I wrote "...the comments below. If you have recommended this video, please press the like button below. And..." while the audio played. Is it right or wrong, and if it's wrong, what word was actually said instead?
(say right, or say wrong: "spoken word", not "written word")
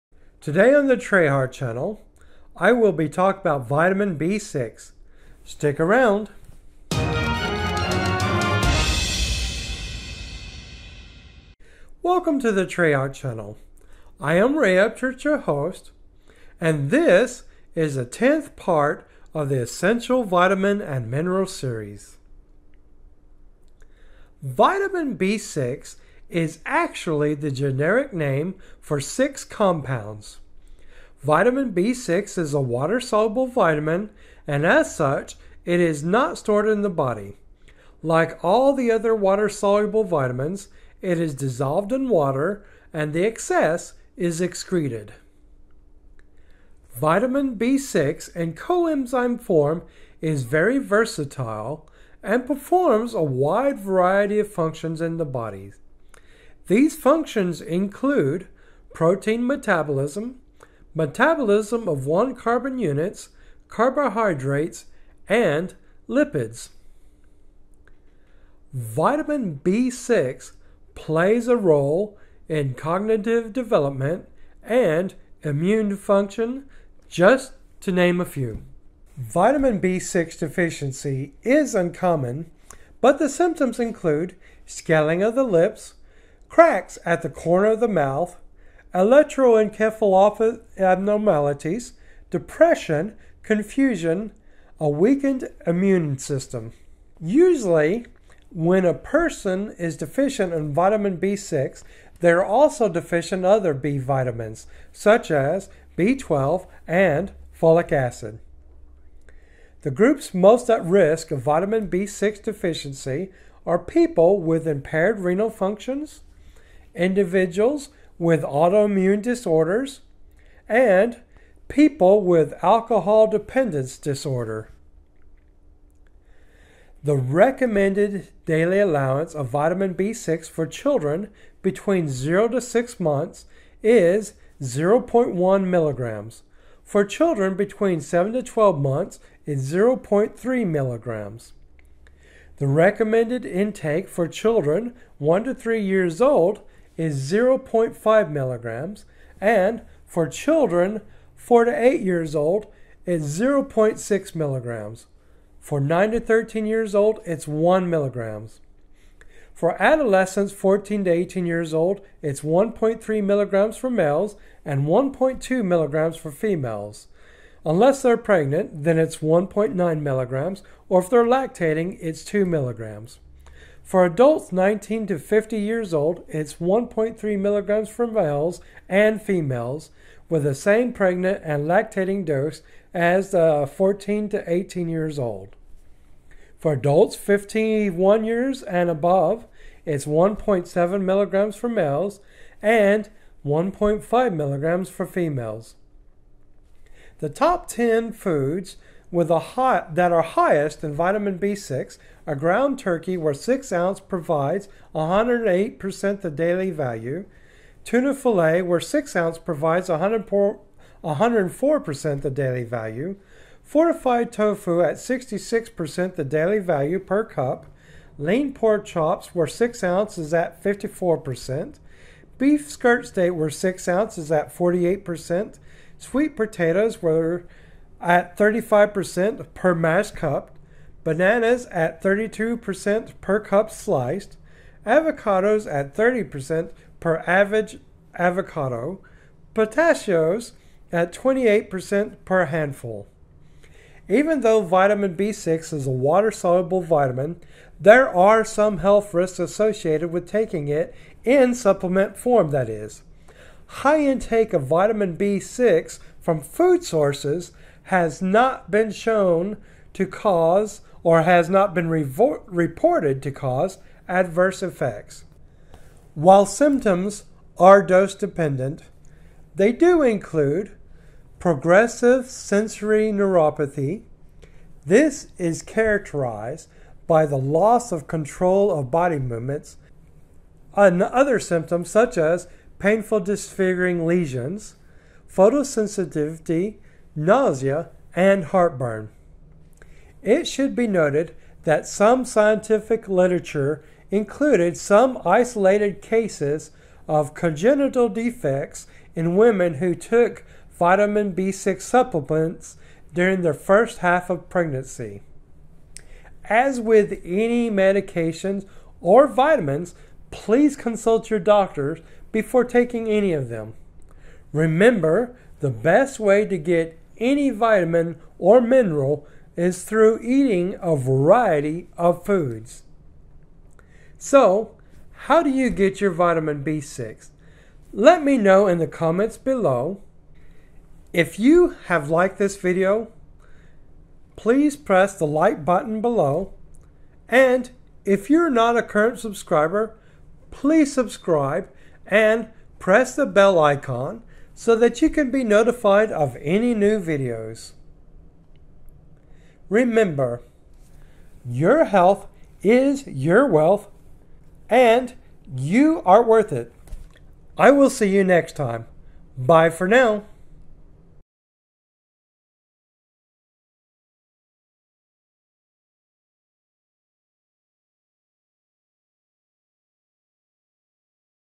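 wrong: "liked", not "recommended".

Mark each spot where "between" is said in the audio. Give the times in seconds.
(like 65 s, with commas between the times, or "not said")
131 s, 137 s.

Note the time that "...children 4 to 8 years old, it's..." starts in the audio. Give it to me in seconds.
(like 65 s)
150 s.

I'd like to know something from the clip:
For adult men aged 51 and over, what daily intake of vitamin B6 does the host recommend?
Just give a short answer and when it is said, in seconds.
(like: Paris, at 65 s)
1.7 milligrams, at 190 s.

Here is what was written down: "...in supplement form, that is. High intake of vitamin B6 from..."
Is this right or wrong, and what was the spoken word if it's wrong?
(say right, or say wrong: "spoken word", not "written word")
right.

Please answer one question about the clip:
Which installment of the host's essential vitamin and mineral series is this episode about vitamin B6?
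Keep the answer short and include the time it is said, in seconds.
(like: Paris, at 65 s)
10th, at 18 s.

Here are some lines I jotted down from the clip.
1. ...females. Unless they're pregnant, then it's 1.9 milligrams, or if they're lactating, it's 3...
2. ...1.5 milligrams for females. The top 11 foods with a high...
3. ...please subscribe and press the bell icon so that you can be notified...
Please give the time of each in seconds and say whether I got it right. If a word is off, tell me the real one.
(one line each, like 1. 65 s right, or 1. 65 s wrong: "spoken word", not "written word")
1. 166 s wrong: "2", not "3"
2. 193 s wrong: "10", not "11"
3. 340 s right.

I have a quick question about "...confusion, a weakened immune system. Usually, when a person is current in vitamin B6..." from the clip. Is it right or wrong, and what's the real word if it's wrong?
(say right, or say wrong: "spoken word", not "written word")
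wrong: "deficient", not "current".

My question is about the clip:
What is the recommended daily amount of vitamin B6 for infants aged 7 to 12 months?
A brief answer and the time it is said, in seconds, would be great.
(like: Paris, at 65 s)
0.3 milligrams, at 139 s.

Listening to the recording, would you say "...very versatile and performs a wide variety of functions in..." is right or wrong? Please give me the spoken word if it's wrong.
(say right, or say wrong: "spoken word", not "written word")
right.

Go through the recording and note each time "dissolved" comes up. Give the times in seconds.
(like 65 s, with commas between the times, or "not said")
41 s.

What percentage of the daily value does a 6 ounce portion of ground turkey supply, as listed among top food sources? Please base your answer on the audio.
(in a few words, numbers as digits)
108%.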